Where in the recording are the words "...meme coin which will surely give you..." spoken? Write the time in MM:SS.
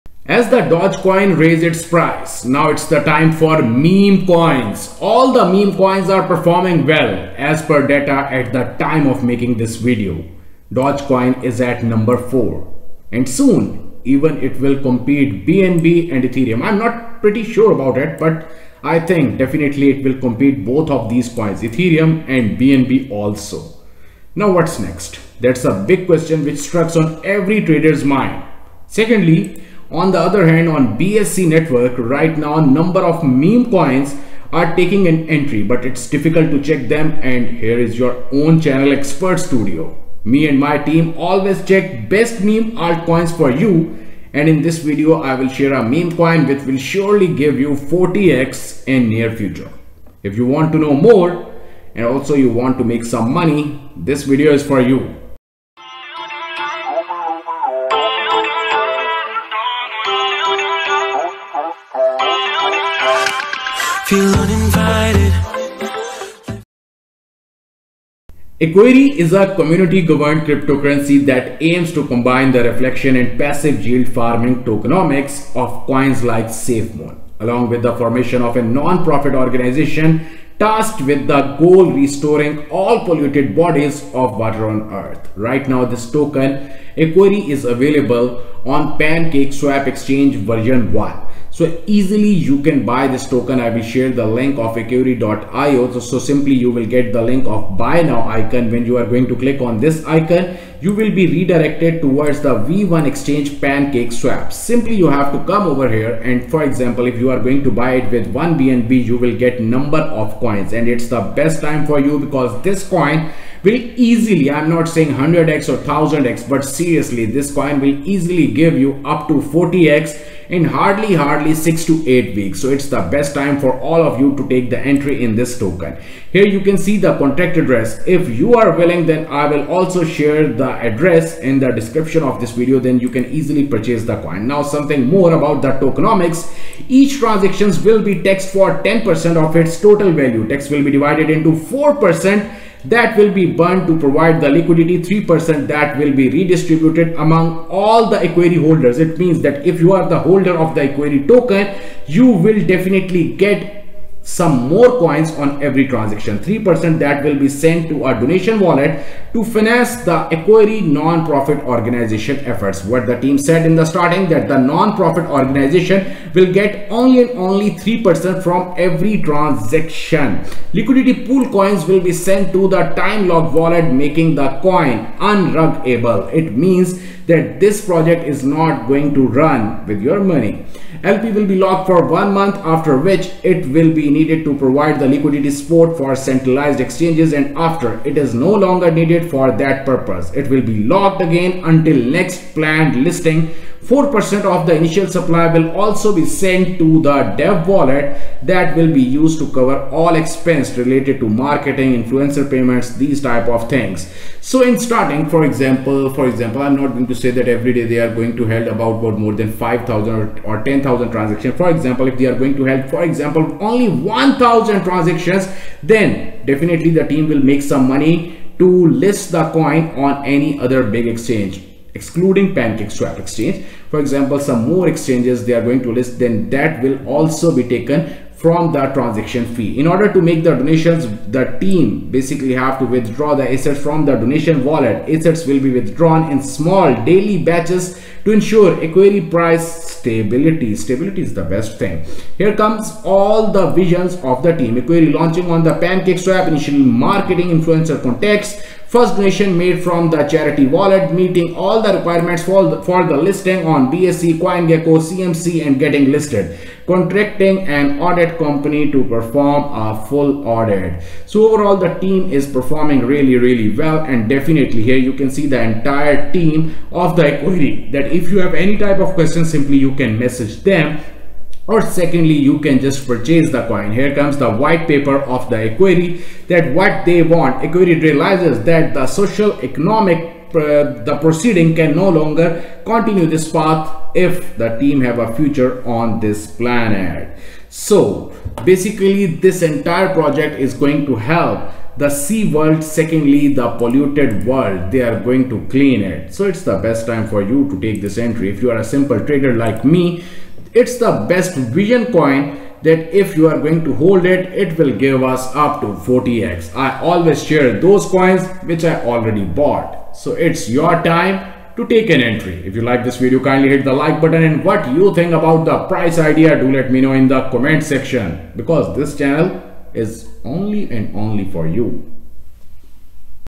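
00:45.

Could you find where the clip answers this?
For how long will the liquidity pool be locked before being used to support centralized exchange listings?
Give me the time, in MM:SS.
03:02.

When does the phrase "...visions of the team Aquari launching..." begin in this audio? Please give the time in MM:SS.
04:03.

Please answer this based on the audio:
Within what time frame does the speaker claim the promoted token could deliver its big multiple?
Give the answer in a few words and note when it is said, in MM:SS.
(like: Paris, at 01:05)
6 to 8 weeks, at 02:01.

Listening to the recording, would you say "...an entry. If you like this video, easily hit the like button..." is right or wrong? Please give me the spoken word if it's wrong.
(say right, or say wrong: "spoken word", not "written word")
wrong: "kindly", not "easily".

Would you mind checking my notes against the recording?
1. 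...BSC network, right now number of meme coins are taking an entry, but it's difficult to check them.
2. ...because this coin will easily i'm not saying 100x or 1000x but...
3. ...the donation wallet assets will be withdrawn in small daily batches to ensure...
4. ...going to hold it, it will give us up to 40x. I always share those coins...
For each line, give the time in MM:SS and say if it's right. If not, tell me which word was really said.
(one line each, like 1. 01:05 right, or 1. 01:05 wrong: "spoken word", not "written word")
1. 00:30 right
2. 01:52 right
3. 03:54 right
4. 05:03 right.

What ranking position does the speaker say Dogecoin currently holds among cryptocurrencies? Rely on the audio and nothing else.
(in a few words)
4.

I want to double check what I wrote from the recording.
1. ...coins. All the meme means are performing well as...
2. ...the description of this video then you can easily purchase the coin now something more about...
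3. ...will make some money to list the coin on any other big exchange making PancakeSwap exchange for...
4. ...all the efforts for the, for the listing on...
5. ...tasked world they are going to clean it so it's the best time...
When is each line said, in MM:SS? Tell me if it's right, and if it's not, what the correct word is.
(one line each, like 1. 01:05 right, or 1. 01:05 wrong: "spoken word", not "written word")
1. 00:04 wrong: "coins", not "means"
2. 02:11 right
3. 03:37 wrong: "excluding", not "making"
4. 04:11 wrong: "requirements", not "efforts"
5. 04:53 wrong: "polluted", not "tasked".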